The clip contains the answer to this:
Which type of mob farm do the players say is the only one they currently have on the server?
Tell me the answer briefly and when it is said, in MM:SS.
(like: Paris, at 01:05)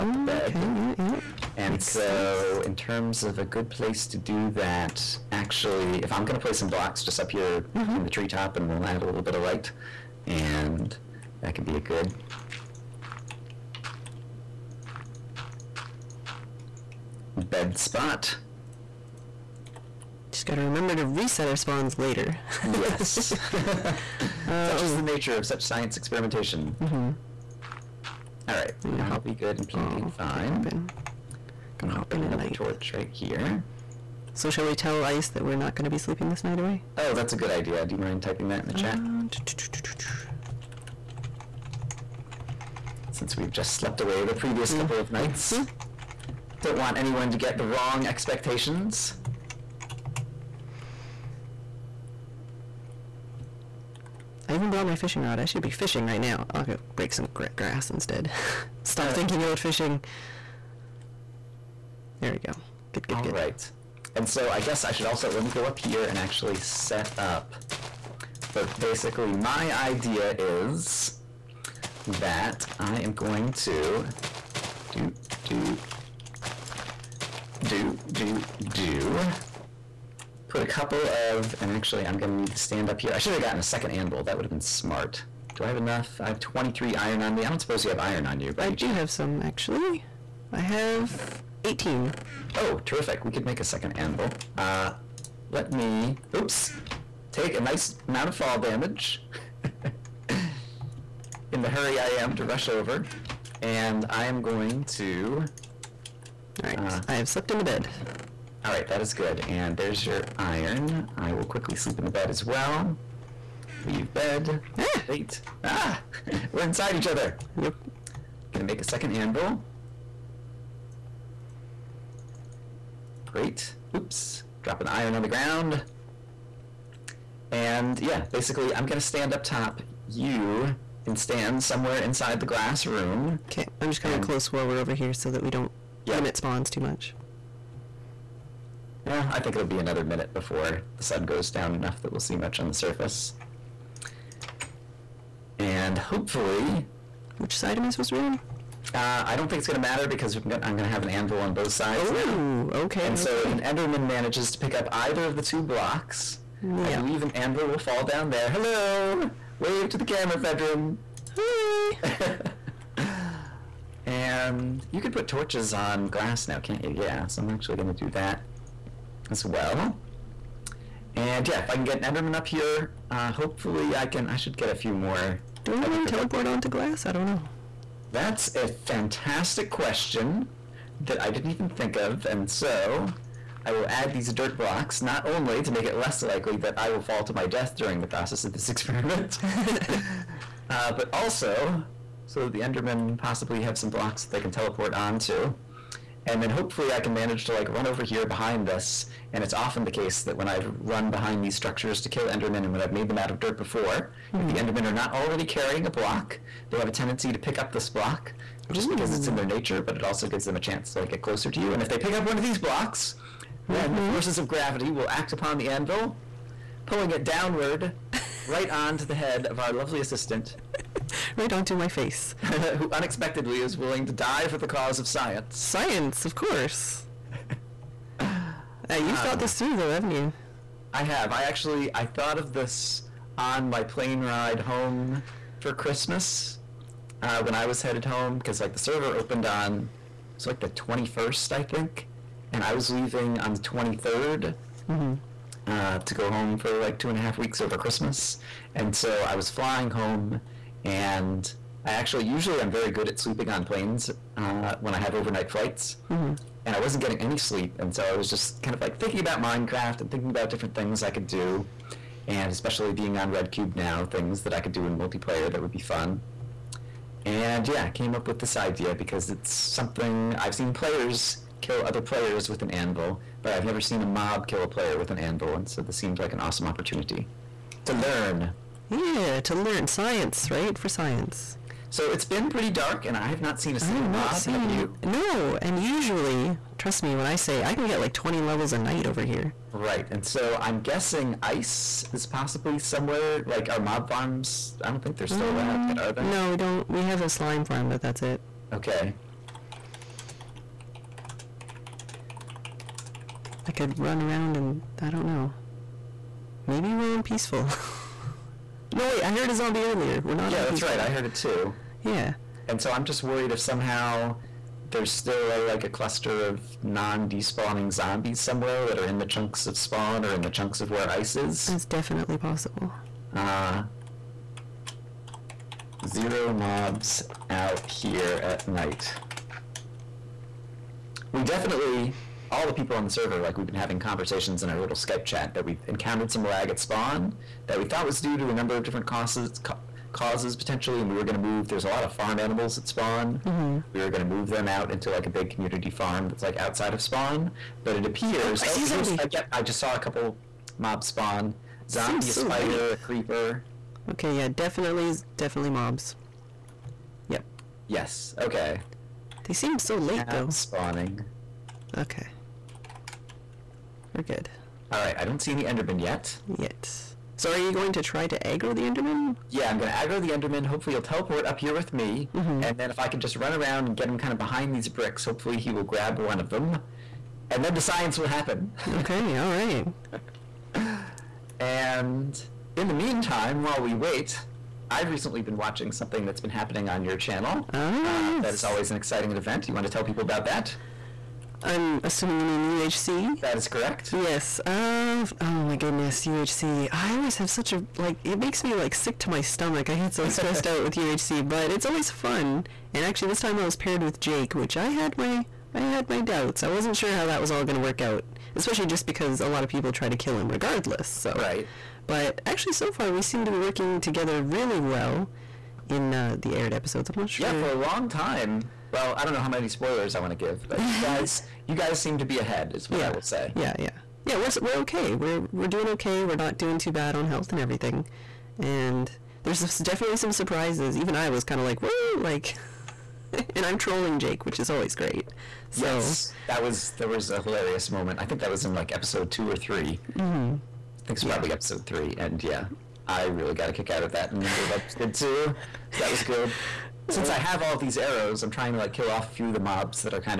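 Slime farm, at 04:57.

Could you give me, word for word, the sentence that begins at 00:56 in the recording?
I'll go break some grass instead.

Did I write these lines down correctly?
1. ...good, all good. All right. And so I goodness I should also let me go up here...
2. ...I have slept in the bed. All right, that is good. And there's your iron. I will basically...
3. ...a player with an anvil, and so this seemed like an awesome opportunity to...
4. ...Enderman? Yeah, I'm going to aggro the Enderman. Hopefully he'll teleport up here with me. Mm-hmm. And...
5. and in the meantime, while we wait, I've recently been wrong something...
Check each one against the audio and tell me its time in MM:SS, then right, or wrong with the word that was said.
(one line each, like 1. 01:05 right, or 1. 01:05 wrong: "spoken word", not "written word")
1. 01:03 wrong: "guess", not "goodness"
2. 01:47 wrong: "quickly", not "basically"
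3. 04:34 right
4. 06:08 right
5. 06:21 wrong: "watching", not "wrong".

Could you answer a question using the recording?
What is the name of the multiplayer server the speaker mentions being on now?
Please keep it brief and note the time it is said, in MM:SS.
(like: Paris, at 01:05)
Red Cube, at 04:23.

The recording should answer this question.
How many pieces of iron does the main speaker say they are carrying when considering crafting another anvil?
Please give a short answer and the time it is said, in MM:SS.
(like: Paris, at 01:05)
23, at 01:26.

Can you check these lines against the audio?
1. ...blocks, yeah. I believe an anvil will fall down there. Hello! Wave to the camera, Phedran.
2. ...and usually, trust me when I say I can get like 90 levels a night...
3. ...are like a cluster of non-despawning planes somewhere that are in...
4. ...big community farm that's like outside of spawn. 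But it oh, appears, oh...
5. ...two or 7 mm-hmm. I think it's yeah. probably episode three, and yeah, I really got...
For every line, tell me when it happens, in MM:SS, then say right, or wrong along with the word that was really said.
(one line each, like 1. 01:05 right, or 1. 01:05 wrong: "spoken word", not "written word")
1. 02:35 right
2. 04:45 wrong: "20", not "90"
3. 05:15 wrong: "zombies", not "planes"
4. 05:45 right
5. 07:19 wrong: "3", not "7".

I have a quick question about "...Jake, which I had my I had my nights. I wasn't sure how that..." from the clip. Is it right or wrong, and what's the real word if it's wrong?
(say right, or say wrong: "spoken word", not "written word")
wrong: "doubts", not "nights".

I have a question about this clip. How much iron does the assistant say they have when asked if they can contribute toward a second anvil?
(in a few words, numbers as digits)
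18.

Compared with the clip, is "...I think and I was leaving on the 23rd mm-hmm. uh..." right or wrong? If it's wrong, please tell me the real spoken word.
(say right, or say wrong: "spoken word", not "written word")
right.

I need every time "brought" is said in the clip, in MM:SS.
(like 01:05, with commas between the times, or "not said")
00:54.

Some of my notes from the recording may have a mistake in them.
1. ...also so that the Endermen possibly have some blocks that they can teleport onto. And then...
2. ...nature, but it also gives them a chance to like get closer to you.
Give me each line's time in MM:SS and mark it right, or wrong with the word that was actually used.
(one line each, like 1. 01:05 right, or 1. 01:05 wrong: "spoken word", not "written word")
1. 03:11 right
2. 03:29 right.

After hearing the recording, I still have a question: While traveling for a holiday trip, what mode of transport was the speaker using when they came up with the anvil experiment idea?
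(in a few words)
Plane.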